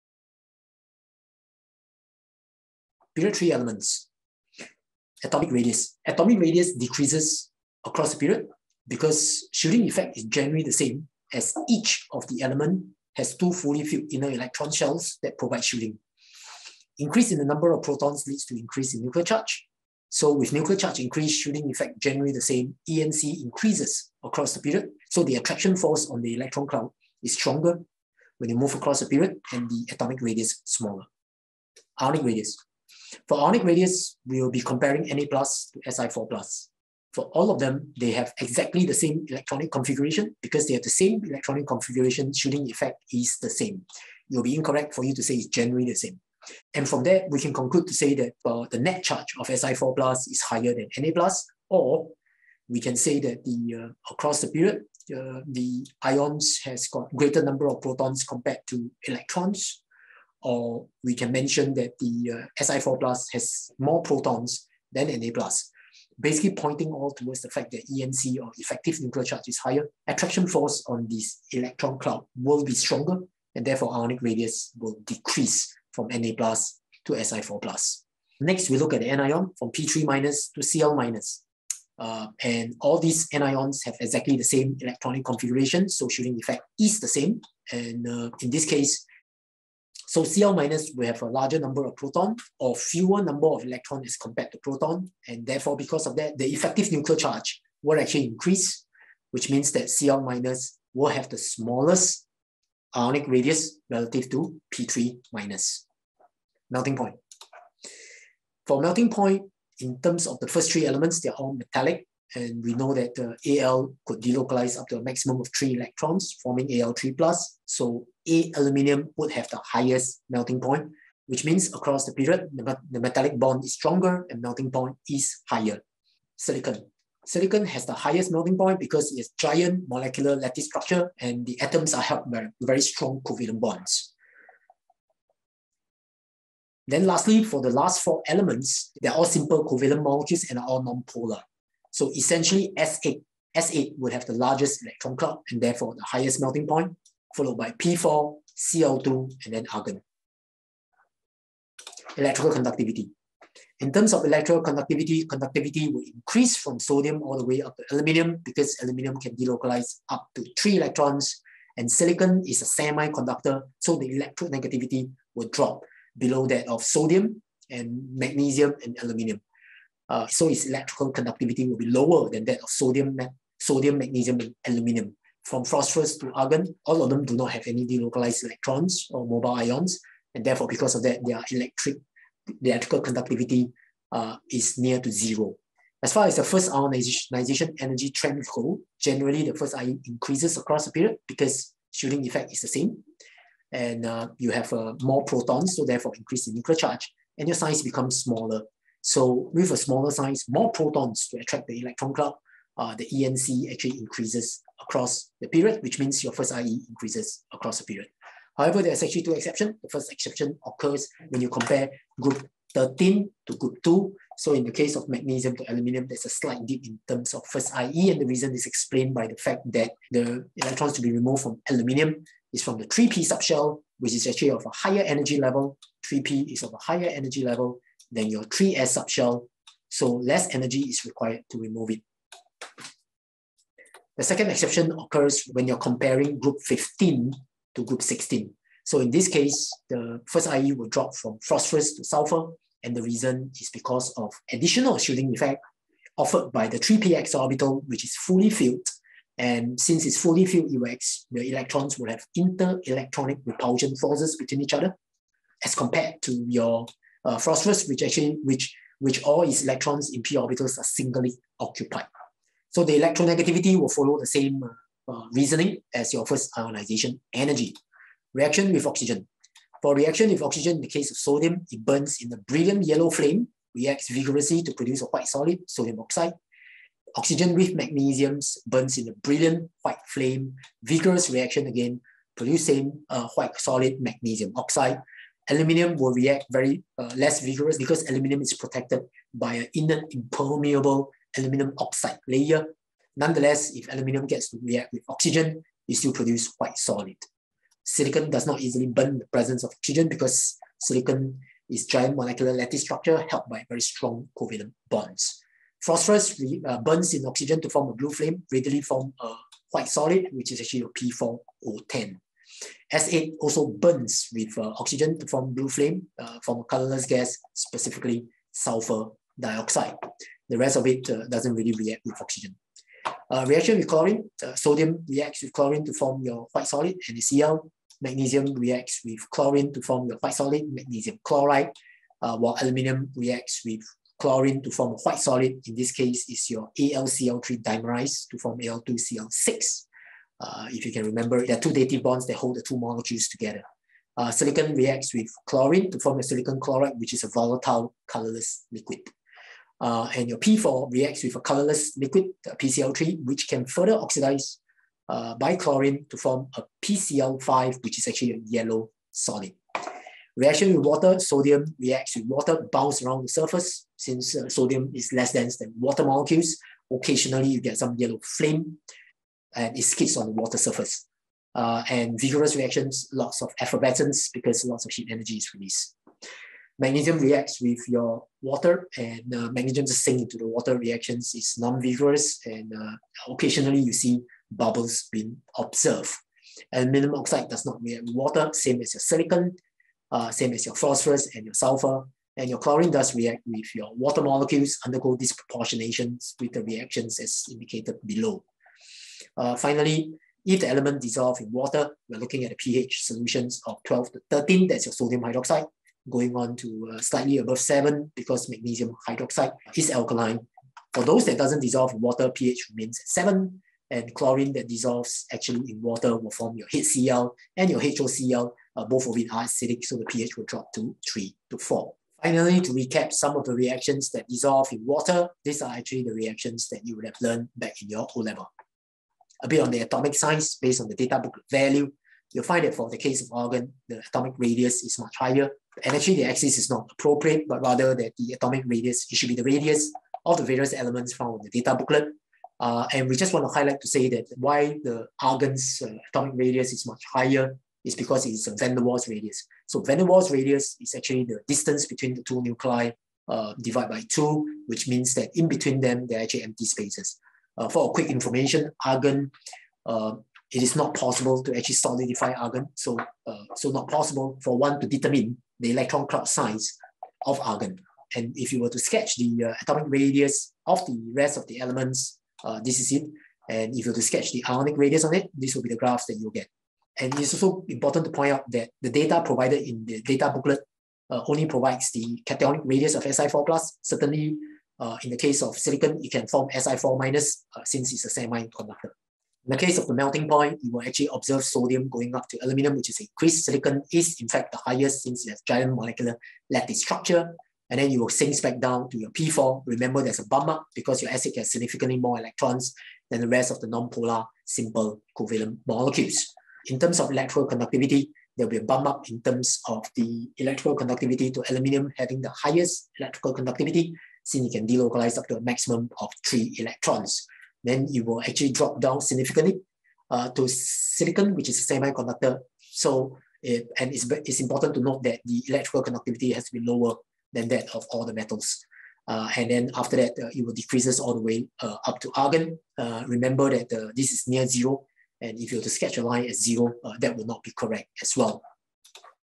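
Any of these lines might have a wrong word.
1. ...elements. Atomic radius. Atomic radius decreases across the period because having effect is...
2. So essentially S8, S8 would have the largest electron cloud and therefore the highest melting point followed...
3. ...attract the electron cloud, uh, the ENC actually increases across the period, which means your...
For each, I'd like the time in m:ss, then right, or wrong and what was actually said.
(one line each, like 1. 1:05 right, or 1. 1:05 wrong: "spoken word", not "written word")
1. 0:03 wrong: "shielding", not "having"
2. 2:21 right
3. 3:21 right.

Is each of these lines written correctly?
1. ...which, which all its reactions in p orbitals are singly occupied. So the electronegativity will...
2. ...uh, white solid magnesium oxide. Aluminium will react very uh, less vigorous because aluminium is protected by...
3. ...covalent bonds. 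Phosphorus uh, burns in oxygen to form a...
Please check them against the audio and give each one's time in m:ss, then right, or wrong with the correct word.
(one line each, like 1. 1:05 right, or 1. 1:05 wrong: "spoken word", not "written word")
1. 4:18 wrong: "electrons", not "reactions"
2. 4:43 right
3. 5:04 right.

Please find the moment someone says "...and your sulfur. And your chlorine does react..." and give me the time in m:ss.
6:31.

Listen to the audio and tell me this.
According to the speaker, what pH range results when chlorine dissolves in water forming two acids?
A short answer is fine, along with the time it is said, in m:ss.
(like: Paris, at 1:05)
3 to 4, at 7:01.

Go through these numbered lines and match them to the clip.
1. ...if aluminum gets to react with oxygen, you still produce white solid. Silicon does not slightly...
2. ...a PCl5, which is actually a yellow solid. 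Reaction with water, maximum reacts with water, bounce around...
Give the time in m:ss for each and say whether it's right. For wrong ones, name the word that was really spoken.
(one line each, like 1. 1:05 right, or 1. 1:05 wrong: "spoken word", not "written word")
1. 4:53 wrong: "easily", not "slightly"
2. 5:56 wrong: "sodium", not "maximum".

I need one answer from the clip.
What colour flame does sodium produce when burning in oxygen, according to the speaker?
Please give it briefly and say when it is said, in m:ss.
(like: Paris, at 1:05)
brilliant yellow, at 4:32.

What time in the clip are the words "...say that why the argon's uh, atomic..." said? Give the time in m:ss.
7:23.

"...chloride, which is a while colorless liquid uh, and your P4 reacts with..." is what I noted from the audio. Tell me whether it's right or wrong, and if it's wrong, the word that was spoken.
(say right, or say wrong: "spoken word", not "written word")
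wrong: "volatile", not "while".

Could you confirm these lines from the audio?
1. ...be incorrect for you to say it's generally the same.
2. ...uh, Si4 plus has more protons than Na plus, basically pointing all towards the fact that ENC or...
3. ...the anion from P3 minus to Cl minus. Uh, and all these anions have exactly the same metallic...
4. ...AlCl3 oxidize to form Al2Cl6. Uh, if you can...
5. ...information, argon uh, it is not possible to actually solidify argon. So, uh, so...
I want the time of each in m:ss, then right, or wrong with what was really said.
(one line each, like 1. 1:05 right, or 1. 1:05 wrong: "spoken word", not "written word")
1. 0:44 right
2. 1:02 right
3. 1:19 wrong: "electronic", not "metallic"
4. 5:36 wrong: "dimerize", not "oxidize"
5. 7:38 right.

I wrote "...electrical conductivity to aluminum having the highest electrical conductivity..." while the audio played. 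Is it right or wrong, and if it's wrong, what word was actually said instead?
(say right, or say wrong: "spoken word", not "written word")
right.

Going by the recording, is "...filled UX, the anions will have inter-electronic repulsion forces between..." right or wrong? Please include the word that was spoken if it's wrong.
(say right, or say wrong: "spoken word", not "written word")
wrong: "electrons", not "anions".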